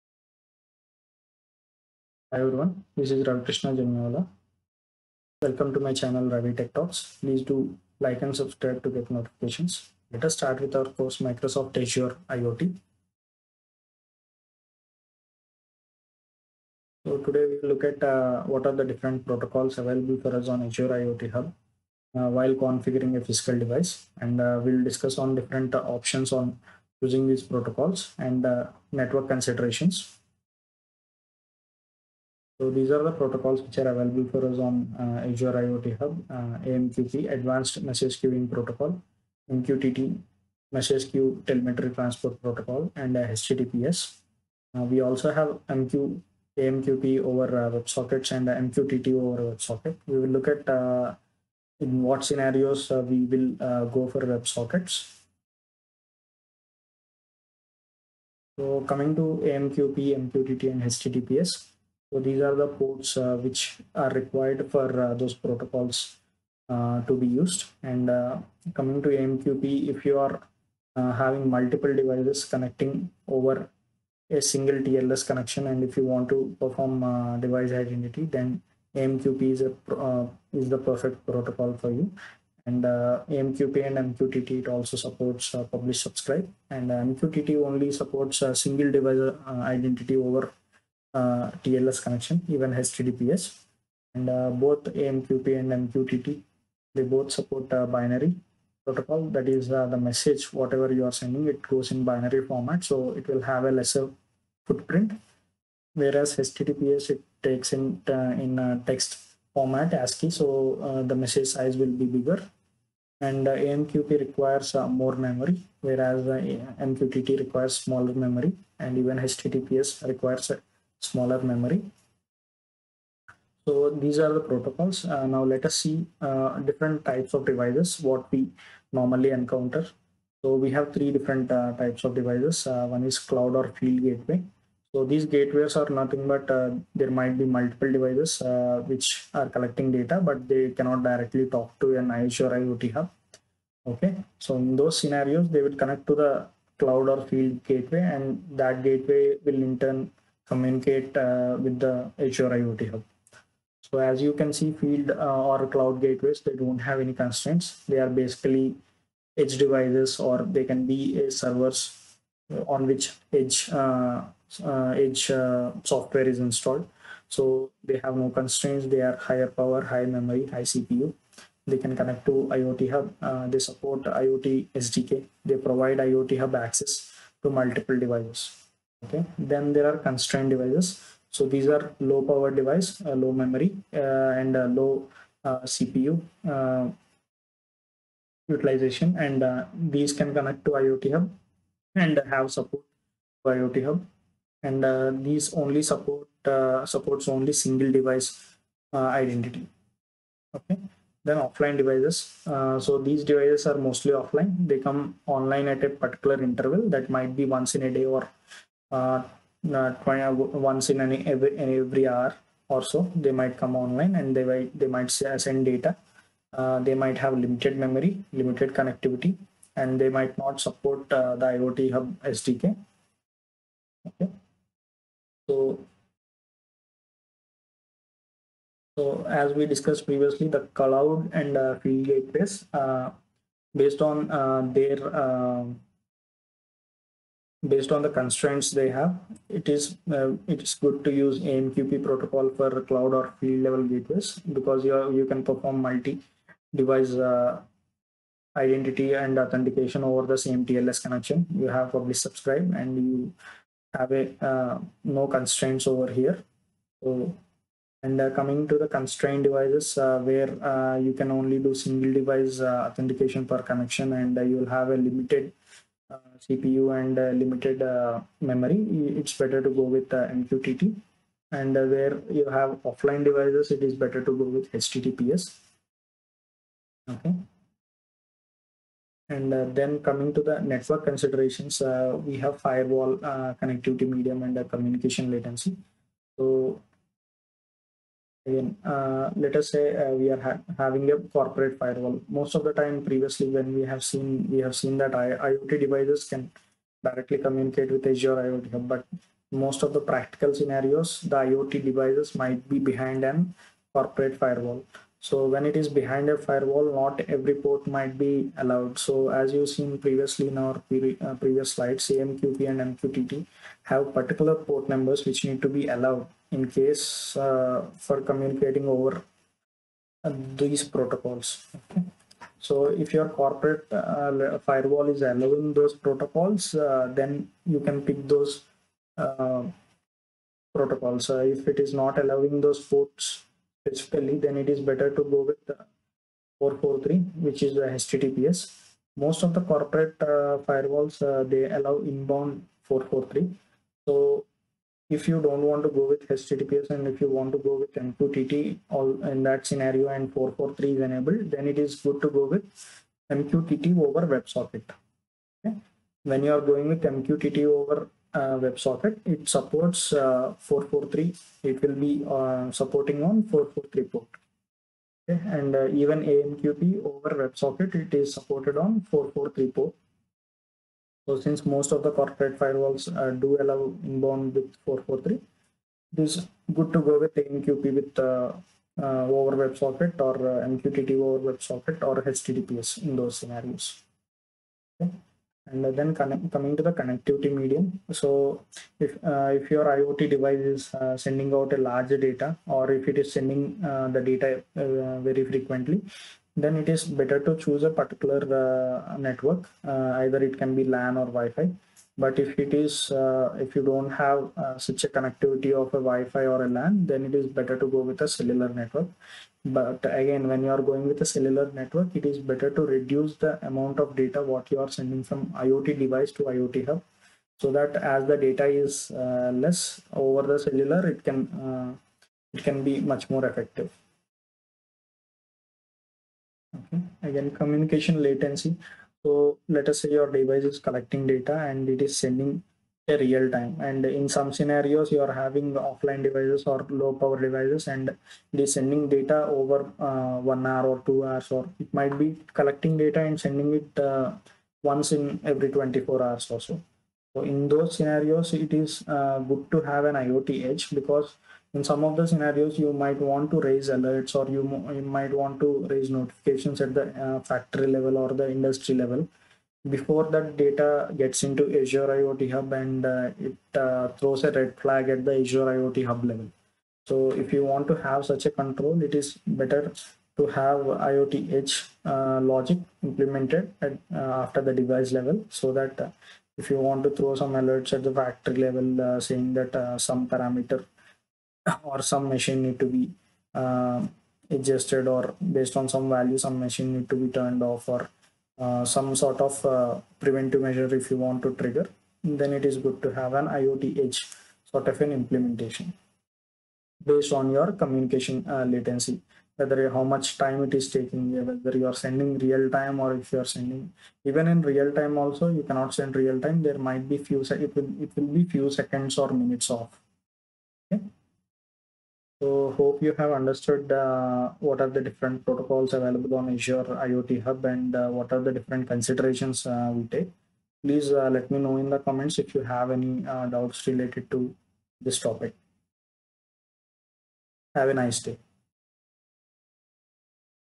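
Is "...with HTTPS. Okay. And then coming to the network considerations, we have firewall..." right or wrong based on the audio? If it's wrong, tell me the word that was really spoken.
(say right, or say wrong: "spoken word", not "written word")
right.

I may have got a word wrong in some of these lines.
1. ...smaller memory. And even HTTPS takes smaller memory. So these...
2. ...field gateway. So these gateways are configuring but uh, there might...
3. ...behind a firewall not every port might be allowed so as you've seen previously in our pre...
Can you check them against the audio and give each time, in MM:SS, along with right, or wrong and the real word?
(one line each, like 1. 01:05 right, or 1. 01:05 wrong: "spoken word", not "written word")
1. 01:57 wrong: "requires", not "takes"
2. 02:13 wrong: "nothing", not "configuring"
3. 05:05 right.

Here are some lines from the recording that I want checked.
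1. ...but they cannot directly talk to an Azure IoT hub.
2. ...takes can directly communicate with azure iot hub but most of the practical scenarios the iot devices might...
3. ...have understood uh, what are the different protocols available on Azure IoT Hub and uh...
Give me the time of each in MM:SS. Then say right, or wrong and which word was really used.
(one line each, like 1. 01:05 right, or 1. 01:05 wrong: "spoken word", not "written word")
1. 02:20 right
2. 04:55 wrong: "devices", not "takes"
3. 08:33 right.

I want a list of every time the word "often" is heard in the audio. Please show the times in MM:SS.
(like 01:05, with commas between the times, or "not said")
not said.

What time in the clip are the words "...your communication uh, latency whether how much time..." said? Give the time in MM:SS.
08:17.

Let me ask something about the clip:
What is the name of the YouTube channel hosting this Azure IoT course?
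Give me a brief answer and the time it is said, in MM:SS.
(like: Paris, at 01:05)
Ravi Tech Talks, at 00:06.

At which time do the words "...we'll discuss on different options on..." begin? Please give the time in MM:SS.
00:24.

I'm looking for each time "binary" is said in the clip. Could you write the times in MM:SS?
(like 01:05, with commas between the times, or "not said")
01:37, 01:42.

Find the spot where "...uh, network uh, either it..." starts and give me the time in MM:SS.
06:38.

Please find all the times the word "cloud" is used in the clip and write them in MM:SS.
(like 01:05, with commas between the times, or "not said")
02:13, 02:26, 02:35, 03:50, 04:02.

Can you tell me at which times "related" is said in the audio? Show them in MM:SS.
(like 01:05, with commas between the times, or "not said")
08:43.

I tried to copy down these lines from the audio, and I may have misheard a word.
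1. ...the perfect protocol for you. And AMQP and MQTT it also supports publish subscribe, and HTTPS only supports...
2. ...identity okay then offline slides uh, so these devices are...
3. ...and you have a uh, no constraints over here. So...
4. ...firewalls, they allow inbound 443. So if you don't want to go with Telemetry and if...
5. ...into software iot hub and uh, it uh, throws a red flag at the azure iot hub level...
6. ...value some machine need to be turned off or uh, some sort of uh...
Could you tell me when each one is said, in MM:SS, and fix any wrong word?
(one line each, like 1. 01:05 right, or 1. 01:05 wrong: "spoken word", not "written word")
1. 01:20 wrong: "MQTT", not "HTTPS"
2. 03:19 wrong: "devices", not "slides"
3. 04:12 right
4. 05:40 wrong: "HTTPS", not "Telemetry"
5. 07:41 wrong: "azure", not "software"
6. 08:06 right.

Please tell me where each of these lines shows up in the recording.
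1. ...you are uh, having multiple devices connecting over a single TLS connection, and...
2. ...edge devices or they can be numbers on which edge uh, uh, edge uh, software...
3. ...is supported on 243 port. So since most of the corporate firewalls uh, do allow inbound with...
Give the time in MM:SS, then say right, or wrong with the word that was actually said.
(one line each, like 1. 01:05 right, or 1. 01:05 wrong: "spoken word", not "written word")
1. 01:10 right
2. 02:39 wrong: "servers", not "numbers"
3. 06:08 wrong: "443", not "243".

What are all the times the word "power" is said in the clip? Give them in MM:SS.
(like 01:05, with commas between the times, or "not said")
02:49, 03:02, 07:17.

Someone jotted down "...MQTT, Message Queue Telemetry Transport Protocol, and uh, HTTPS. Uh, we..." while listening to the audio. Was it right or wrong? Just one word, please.
right.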